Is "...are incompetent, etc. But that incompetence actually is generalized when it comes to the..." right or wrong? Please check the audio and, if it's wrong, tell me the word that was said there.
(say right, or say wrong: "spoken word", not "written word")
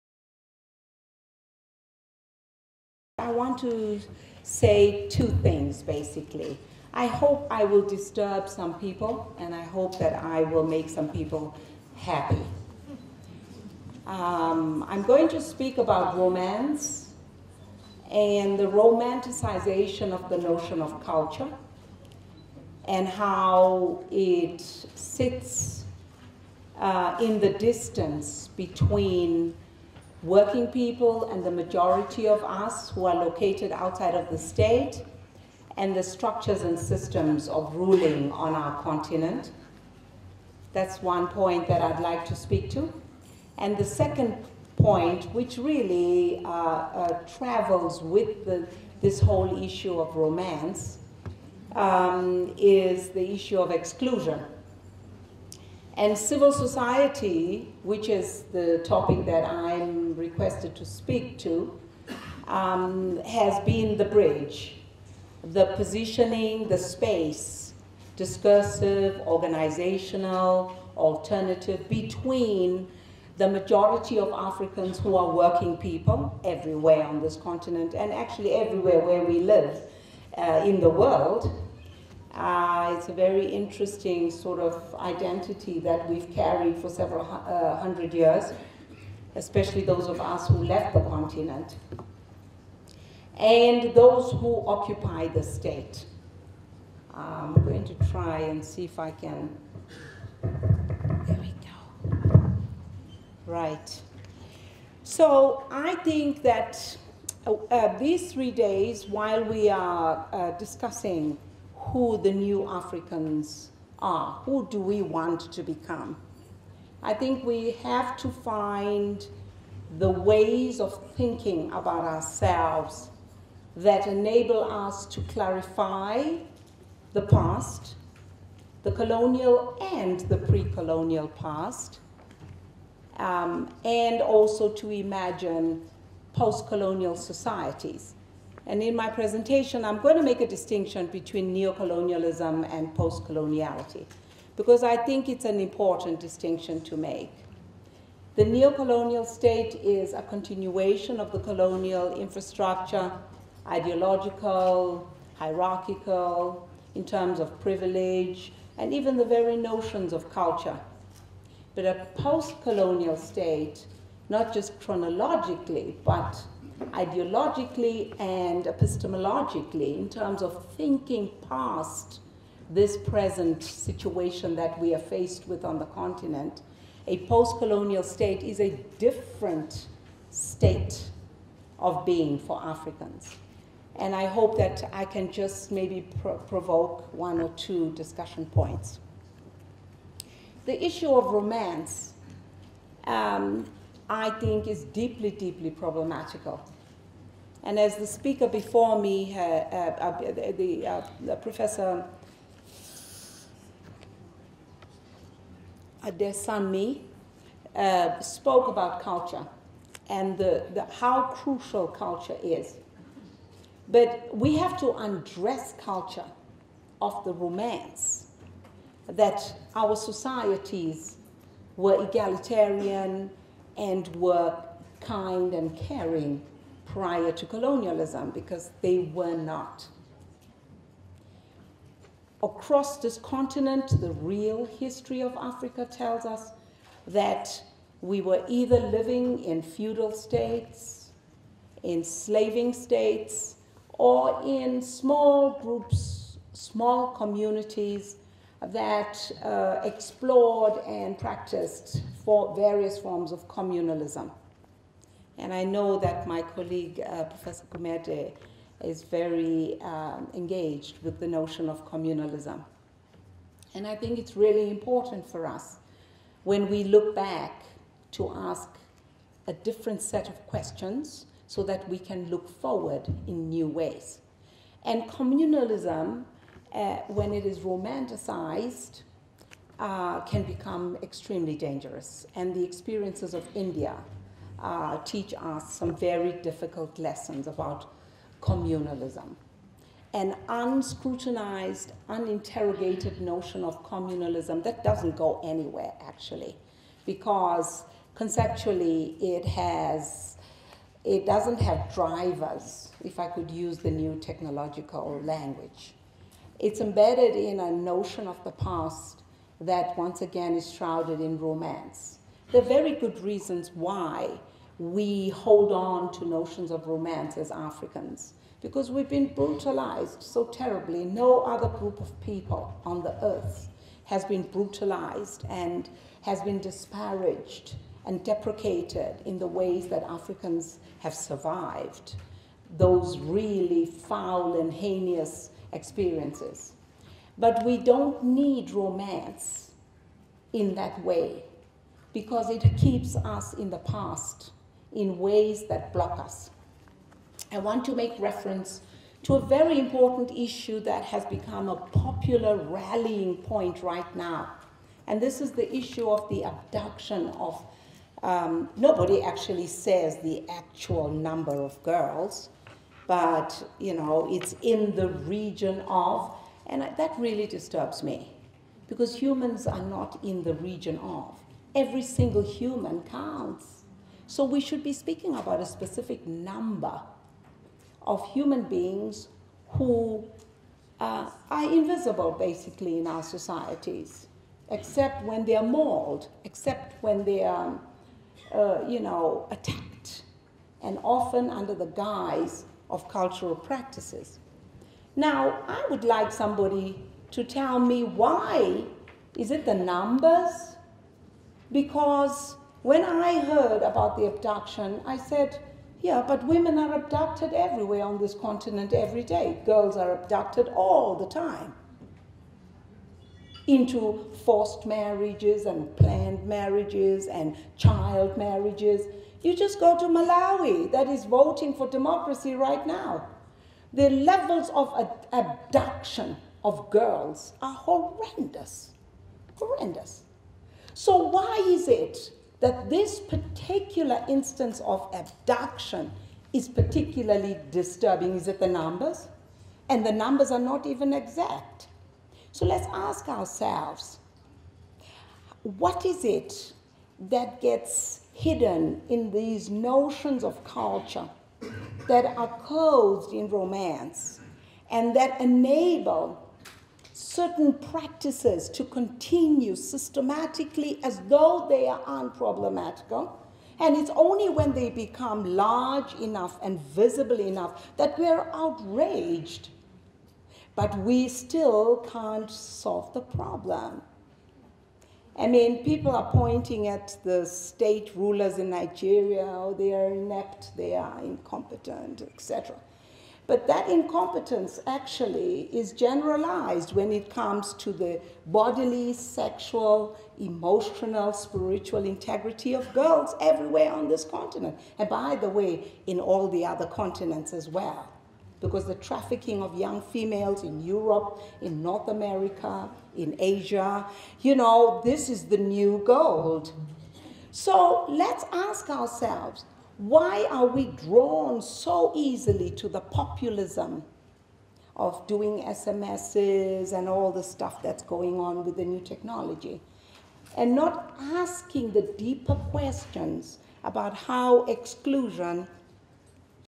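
right.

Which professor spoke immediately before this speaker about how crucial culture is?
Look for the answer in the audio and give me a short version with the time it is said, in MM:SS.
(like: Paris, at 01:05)
Professor Desanmi, at 03:21.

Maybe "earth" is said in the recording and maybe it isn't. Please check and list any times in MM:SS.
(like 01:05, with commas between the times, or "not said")
05:23.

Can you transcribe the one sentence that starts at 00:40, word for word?
That's one point that I'd like to speak to.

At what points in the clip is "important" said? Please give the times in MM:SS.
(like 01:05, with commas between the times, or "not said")
02:25, 04:24, 05:49.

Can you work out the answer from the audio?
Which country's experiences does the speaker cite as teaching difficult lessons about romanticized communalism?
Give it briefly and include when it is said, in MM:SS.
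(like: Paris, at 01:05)
India, at 04:43.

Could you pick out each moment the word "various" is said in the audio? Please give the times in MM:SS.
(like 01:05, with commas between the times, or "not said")
04:12.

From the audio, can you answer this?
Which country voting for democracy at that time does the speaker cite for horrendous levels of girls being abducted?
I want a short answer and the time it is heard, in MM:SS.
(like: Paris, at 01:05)
Malawi, at 07:00.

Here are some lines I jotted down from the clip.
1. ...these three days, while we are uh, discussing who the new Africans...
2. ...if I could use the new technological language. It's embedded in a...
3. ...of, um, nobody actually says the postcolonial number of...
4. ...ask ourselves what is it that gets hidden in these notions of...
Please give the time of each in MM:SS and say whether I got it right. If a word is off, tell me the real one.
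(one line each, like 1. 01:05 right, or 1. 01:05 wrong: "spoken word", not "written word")
1. 01:47 right
2. 05:03 right
3. 05:57 wrong: "actual", not "postcolonial"
4. 07:22 right.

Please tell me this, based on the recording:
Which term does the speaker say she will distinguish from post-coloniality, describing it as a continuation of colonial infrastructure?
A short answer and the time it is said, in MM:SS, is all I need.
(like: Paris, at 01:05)
neocolonialism, at 02:21.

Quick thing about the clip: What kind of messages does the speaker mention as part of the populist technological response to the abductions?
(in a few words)
SMSs.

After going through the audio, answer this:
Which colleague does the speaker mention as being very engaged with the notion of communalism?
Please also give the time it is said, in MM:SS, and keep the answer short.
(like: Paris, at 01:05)
Professor Kumete, at 04:17.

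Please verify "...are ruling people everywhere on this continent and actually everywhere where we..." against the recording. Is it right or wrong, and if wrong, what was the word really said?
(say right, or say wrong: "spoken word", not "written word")
wrong: "working", not "ruling".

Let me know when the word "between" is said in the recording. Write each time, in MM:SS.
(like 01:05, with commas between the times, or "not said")
00:28, 01:11, 02:21.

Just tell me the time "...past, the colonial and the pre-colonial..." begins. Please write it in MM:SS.
02:07.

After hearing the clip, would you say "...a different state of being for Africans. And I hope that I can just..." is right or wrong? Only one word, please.
right.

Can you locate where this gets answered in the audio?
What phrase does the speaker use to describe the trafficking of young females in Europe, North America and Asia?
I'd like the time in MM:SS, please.
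08:25.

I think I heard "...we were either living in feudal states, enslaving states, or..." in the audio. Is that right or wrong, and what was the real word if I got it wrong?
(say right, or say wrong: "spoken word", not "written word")
right.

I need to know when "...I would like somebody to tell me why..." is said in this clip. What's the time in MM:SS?
06:35.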